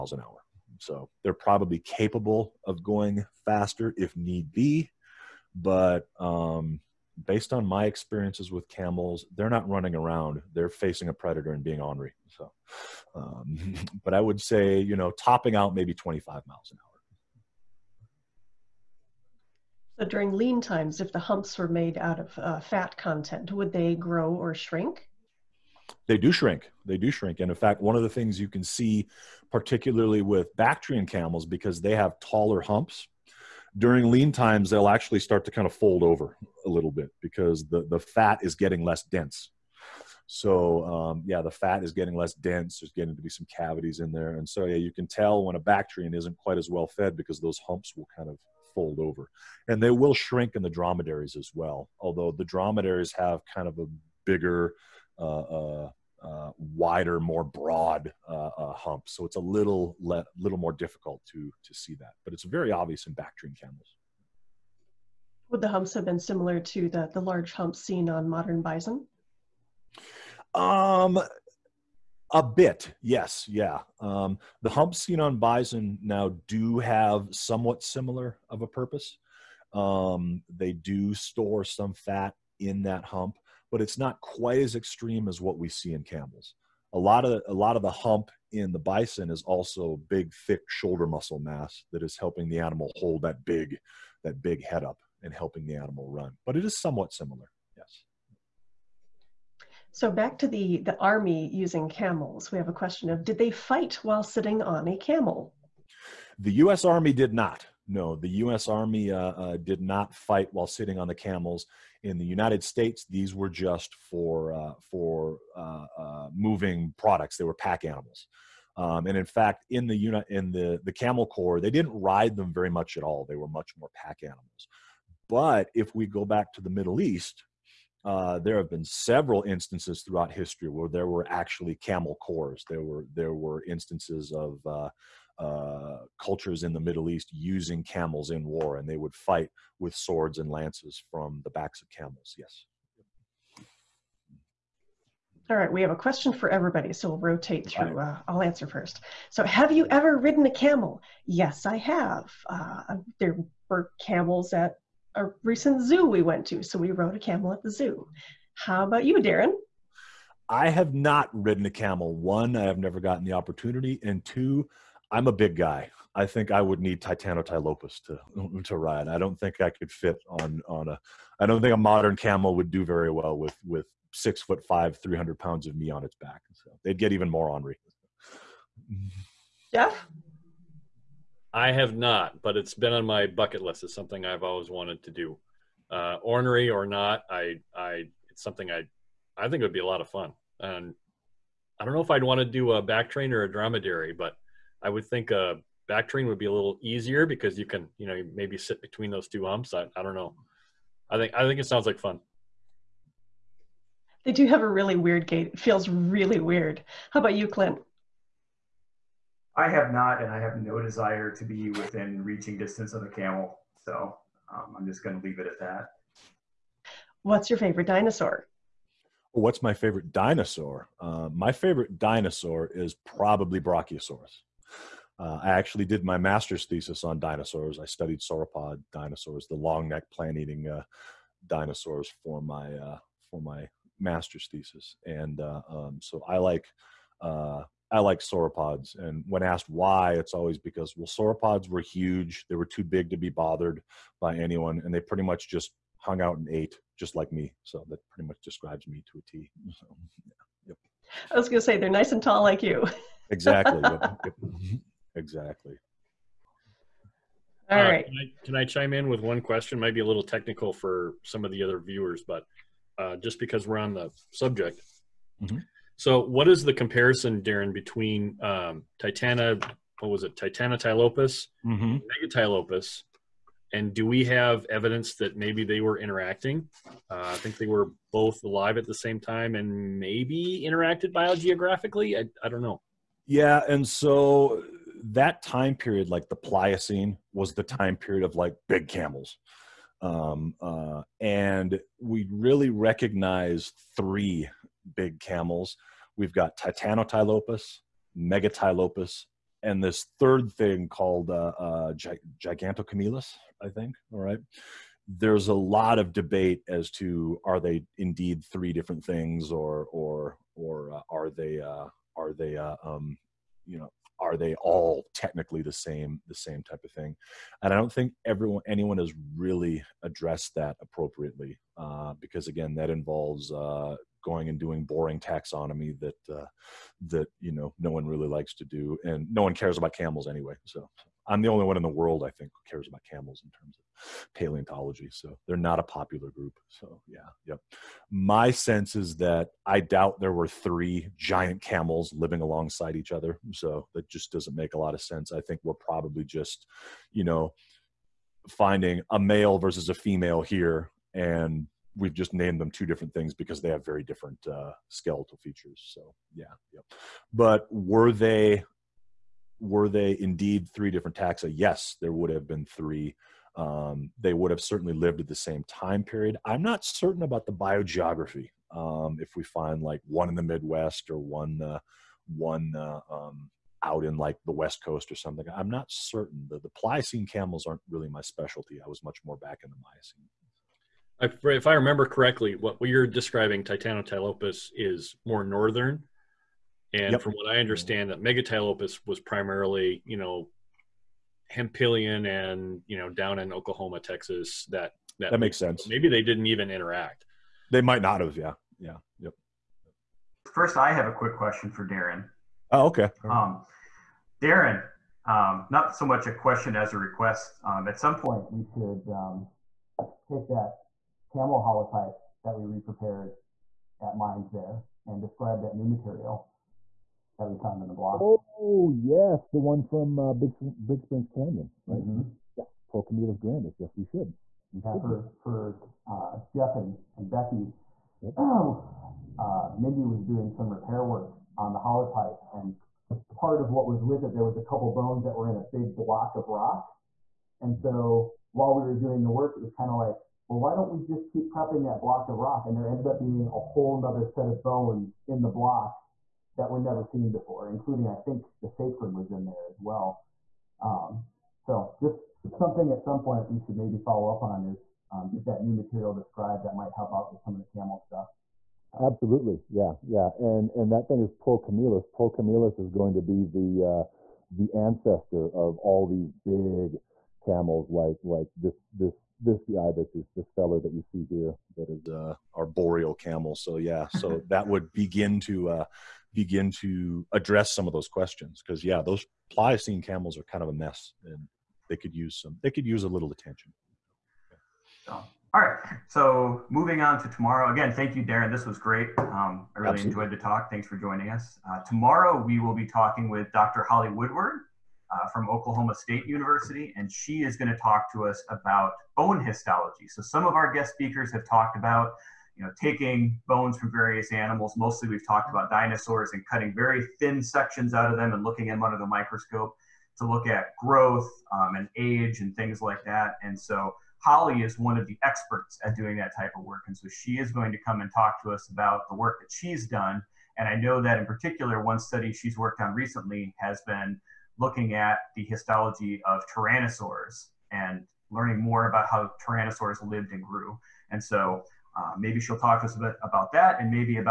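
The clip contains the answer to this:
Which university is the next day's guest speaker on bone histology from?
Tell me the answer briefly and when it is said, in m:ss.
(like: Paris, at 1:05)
Oklahoma State University, at 8:15.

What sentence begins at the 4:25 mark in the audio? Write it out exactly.
So, what is the comparison, Darrin, between um, Titana, what was it, Titana tylopus, mm-hmm.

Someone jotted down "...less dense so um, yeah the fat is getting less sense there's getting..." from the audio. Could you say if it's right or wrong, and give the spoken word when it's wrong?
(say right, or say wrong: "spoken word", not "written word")
wrong: "dense", not "sense".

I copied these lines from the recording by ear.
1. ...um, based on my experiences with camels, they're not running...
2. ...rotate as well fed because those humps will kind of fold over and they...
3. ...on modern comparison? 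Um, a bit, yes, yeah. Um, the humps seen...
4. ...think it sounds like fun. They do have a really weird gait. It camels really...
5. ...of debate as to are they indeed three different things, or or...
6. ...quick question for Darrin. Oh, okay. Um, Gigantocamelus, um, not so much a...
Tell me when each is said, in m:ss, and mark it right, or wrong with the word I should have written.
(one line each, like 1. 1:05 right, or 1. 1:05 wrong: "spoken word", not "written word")
1. 0:06 right
2. 0:46 wrong: "quite", not "rotate"
3. 1:08 wrong: "bison", not "comparison"
4. 3:21 wrong: "feels", not "camels"
5. 5:05 right
6. 6:41 wrong: "Darrin", not "Gigantocamelus".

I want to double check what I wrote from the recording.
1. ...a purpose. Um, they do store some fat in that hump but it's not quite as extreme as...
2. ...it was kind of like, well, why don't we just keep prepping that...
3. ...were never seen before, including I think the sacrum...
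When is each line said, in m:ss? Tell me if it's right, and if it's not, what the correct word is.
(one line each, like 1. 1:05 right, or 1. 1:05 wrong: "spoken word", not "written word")
1. 1:18 right
2. 7:19 right
3. 7:26 right.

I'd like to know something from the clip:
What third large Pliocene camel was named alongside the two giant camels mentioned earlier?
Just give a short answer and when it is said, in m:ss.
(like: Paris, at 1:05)
Gigantocamelus, at 5:02.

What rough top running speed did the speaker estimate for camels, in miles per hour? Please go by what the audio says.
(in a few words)
25.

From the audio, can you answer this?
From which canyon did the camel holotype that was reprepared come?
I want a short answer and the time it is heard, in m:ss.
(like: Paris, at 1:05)
Big Springs Canyon, at 7:00.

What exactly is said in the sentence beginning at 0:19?
So during lean times, if the humps were made out of uh, fat content, would they grow or shrink?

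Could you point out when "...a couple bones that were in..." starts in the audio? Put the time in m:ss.
7:14.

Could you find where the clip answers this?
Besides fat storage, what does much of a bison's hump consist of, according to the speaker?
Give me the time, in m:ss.
1:30.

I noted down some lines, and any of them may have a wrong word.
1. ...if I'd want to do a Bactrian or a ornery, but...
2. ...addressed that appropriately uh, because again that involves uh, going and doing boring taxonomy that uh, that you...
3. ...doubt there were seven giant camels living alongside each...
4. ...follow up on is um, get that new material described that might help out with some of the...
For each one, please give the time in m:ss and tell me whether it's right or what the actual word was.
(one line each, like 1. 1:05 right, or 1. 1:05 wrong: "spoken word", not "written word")
1. 3:11 wrong: "dromedary", not "ornery"
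2. 5:20 right
3. 5:39 wrong: "three", not "seven"
4. 7:33 right.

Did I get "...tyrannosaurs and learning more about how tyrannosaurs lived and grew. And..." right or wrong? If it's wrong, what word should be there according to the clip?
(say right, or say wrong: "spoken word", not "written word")
right.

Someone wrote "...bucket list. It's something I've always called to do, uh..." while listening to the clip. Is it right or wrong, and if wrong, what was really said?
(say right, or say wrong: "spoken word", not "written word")
wrong: "wanted", not "called".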